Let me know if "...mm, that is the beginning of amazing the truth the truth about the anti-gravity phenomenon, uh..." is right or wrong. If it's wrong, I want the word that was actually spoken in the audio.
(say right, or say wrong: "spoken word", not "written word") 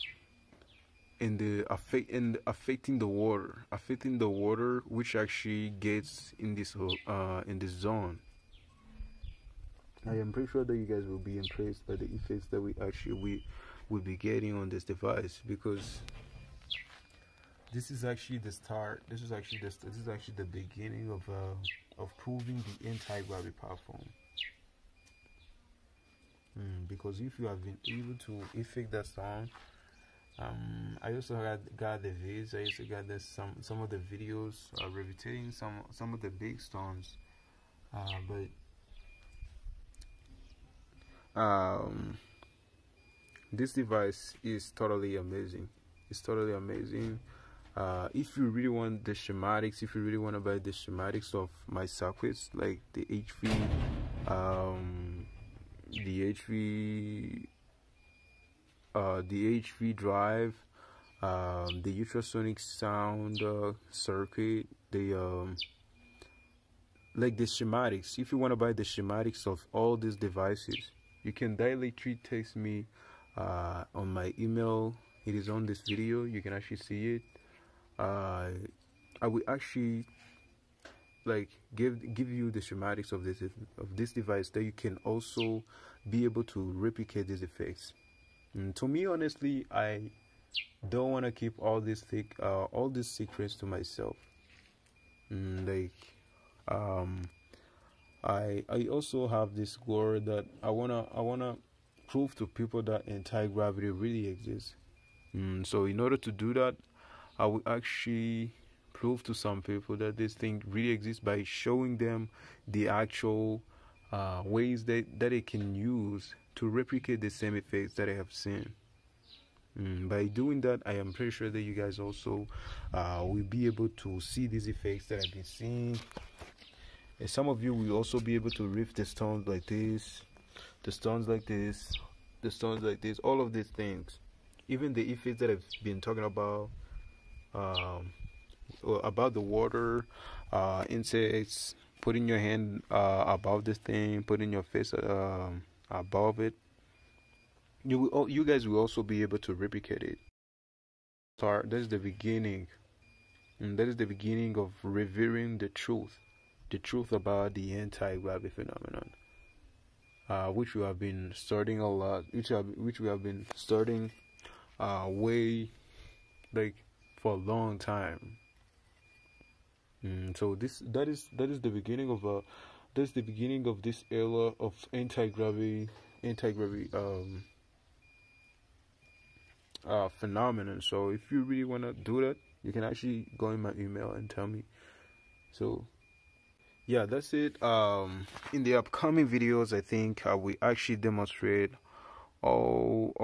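wrong: "revering", not "amazing".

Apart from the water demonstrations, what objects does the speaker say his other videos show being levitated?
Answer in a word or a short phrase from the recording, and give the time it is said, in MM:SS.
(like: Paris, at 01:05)
big stones, at 00:36.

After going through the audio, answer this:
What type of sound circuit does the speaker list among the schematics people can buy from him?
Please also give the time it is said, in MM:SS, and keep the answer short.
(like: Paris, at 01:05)
ultrasonic sound, at 01:01.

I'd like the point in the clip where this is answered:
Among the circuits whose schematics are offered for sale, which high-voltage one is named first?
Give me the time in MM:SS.
00:59.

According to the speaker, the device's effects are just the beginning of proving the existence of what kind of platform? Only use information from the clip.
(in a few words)
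anti-gravity platform.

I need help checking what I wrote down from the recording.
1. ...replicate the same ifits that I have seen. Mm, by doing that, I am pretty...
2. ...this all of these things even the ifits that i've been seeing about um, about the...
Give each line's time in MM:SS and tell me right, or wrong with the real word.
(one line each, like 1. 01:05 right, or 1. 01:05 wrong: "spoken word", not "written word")
1. 01:56 wrong: "effects", not "ifits"
2. 02:13 wrong: "talking", not "seeing".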